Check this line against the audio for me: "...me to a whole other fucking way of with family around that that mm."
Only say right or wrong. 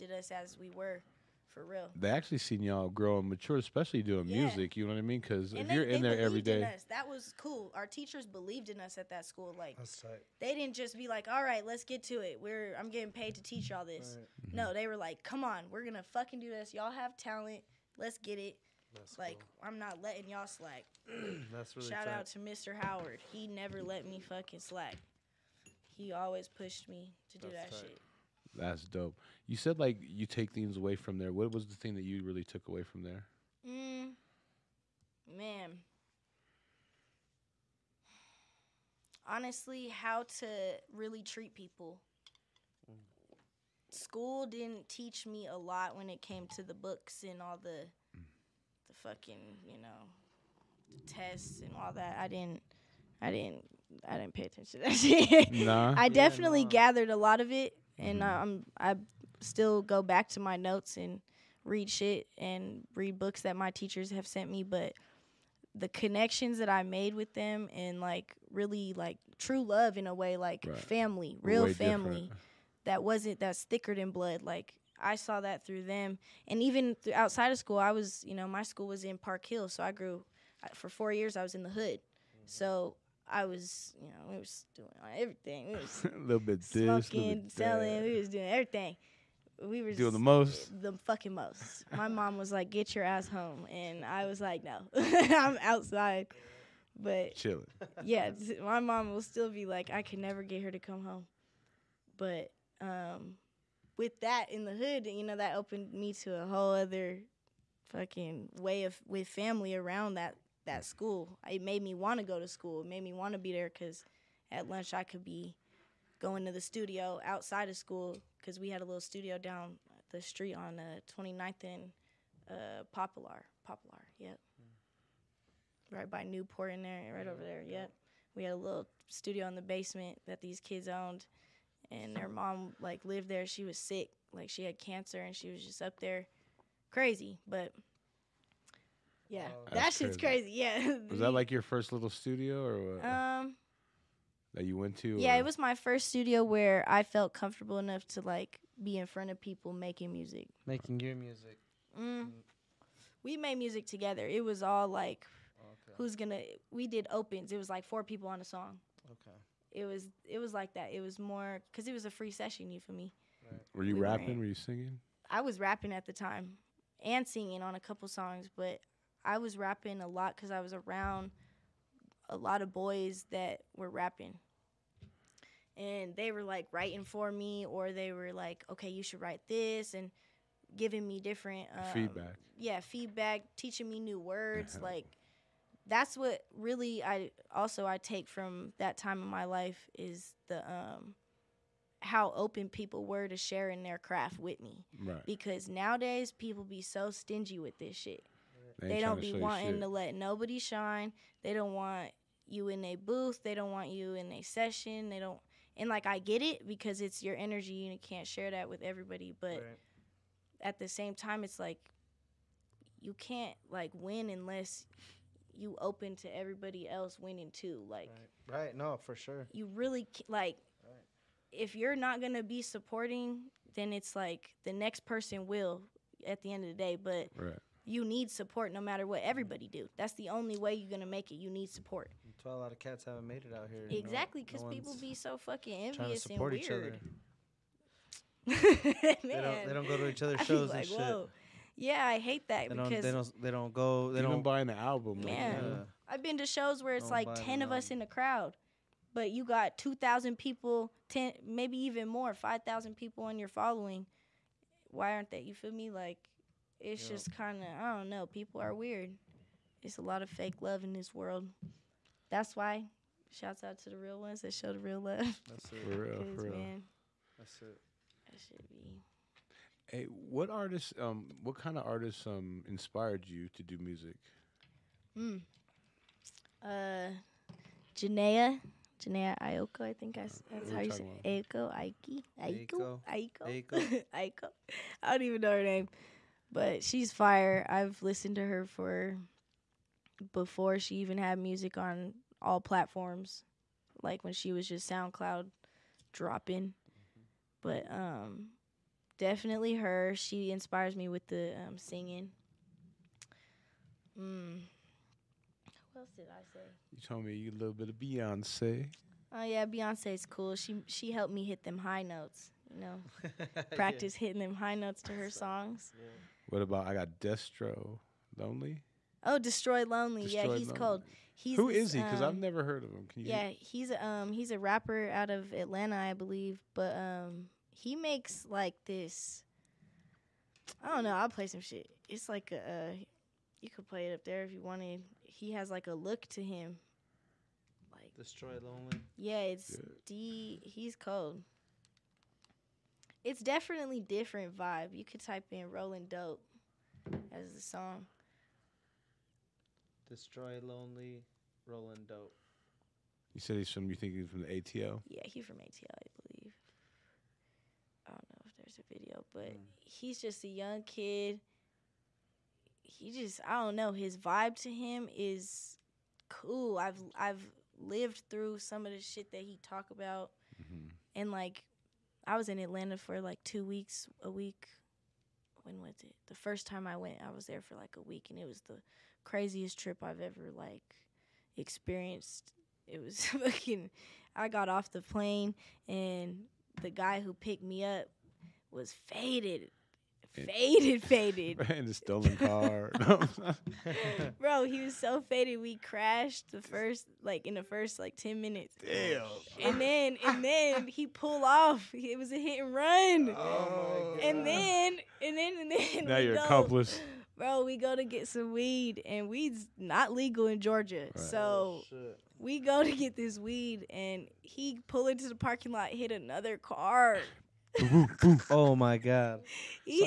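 right.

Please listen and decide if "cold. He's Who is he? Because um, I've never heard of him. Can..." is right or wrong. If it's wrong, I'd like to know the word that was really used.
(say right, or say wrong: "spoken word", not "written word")
right.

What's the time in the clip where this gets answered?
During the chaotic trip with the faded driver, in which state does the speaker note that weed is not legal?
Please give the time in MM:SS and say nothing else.
06:50.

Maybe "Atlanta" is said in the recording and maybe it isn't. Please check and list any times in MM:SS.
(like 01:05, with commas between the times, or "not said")
05:25, 06:12.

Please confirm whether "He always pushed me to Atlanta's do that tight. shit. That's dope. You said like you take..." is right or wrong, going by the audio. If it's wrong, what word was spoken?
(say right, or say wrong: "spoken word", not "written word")
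wrong: "That", not "Atlanta".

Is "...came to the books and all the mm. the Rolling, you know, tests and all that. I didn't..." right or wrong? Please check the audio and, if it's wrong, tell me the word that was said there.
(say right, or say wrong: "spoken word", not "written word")
wrong: "fucking", not "Rolling".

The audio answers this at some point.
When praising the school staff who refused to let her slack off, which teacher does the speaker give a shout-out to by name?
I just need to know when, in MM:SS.
00:22.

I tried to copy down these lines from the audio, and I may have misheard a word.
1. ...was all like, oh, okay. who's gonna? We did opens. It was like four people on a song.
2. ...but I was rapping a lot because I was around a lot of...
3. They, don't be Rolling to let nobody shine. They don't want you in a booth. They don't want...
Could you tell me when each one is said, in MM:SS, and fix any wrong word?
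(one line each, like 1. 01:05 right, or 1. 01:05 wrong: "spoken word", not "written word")
1. 02:34 right
2. 02:48 right
3. 03:18 wrong: "wanting", not "Rolling".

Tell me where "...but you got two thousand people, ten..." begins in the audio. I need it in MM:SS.
04:09.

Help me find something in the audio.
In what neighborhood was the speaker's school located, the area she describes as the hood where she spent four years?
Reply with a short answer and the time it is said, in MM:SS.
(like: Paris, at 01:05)
Park Hill, at 01:19.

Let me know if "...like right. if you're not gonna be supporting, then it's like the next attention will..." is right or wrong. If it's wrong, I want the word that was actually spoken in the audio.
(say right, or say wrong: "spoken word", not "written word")
wrong: "person", not "attention".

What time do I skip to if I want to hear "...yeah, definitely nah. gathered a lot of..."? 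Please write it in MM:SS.
00:56.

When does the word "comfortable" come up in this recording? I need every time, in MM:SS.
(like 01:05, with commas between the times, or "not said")
02:27.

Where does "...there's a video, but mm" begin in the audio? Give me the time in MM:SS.
05:58.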